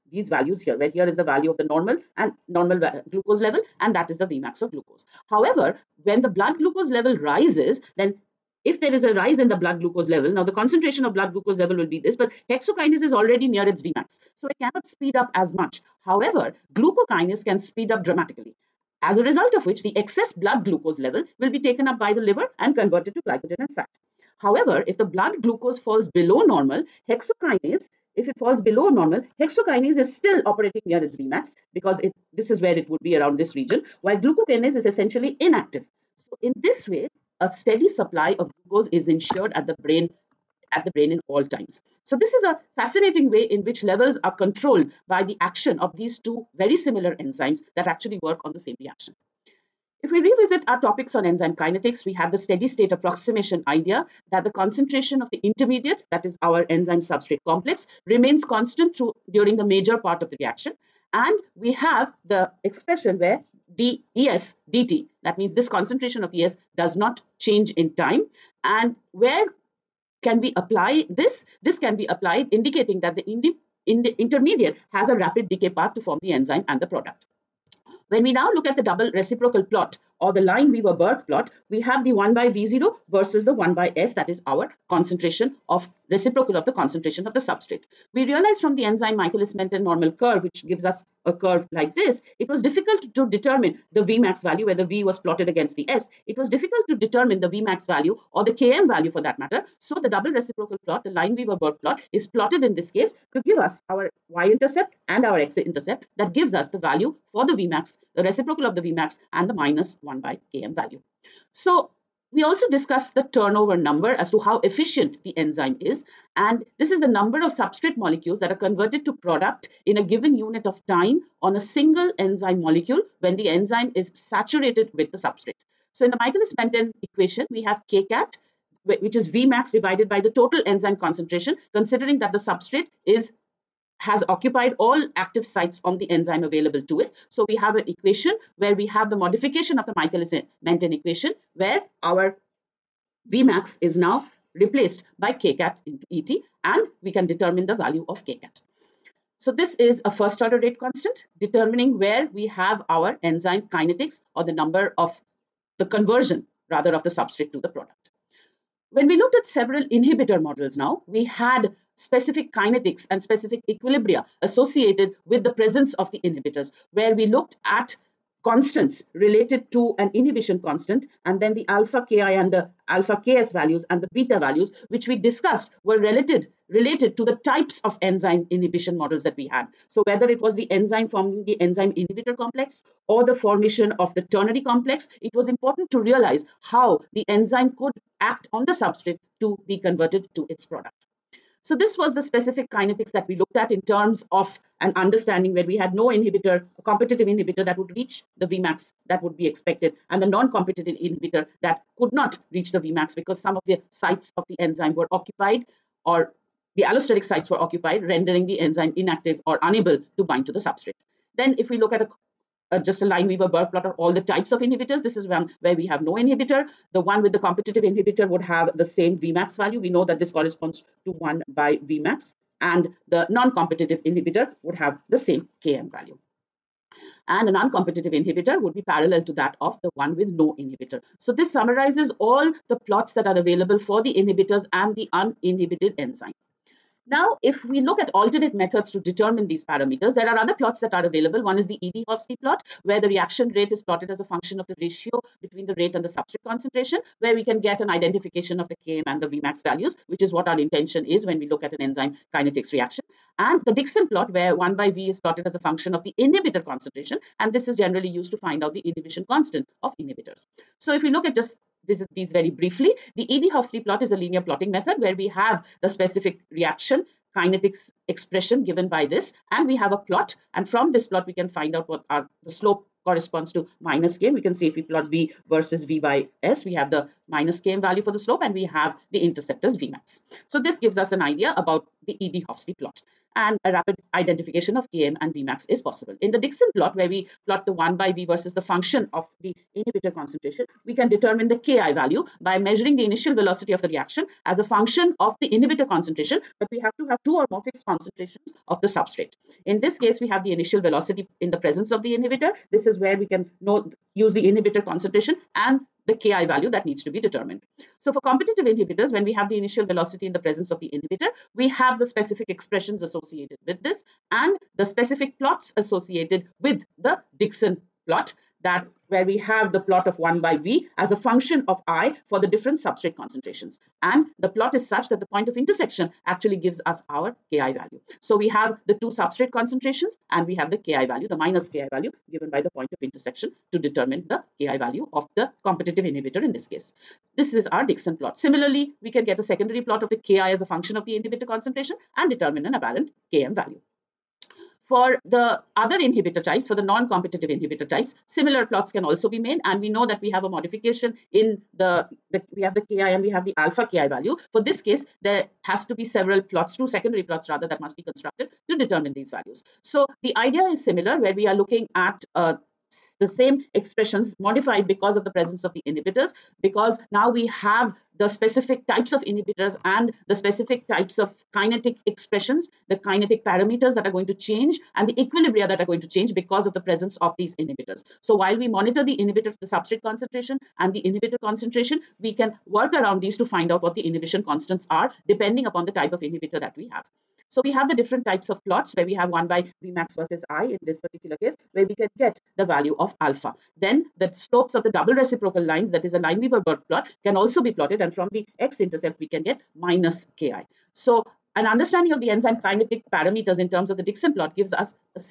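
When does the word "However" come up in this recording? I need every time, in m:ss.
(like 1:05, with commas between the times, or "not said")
0:05, 0:16, 0:24.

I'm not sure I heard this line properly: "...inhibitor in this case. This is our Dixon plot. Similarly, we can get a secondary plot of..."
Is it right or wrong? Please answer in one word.
right.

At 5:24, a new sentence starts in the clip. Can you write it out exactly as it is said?
And the plot is such that the point of intersection actually gives us our Ki value.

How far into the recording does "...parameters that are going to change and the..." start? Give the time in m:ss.
6:13.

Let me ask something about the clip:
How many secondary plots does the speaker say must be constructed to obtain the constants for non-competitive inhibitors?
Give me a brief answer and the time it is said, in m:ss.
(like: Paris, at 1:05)
2, at 5:56.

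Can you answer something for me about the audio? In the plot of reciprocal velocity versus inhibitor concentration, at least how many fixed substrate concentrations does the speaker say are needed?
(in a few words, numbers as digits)
2 or more.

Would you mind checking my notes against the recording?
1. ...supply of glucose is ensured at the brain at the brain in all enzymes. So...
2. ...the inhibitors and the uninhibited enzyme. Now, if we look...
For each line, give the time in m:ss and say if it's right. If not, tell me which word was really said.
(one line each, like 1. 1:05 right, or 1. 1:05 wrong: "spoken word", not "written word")
1. 0:37 wrong: "times", not "enzymes"
2. 3:54 right.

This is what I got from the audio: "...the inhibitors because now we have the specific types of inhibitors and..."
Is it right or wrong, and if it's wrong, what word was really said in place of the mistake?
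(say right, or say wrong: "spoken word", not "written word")
right.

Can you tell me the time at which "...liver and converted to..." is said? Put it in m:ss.
0:22.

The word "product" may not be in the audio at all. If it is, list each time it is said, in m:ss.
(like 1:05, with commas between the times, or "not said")
1:16, 1:59, 2:37, 3:10.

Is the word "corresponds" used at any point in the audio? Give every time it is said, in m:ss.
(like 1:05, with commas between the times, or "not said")
3:40, 4:33.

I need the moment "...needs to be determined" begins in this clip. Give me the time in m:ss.
5:06.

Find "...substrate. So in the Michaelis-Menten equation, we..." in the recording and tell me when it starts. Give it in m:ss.
2:05.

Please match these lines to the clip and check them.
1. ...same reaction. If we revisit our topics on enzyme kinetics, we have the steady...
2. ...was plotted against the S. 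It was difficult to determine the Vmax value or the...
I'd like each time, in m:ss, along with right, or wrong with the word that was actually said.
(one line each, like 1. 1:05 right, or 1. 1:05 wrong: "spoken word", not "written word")
1. 0:48 right
2. 1:35 right.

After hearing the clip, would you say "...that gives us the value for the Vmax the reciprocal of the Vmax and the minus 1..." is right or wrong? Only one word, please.
right.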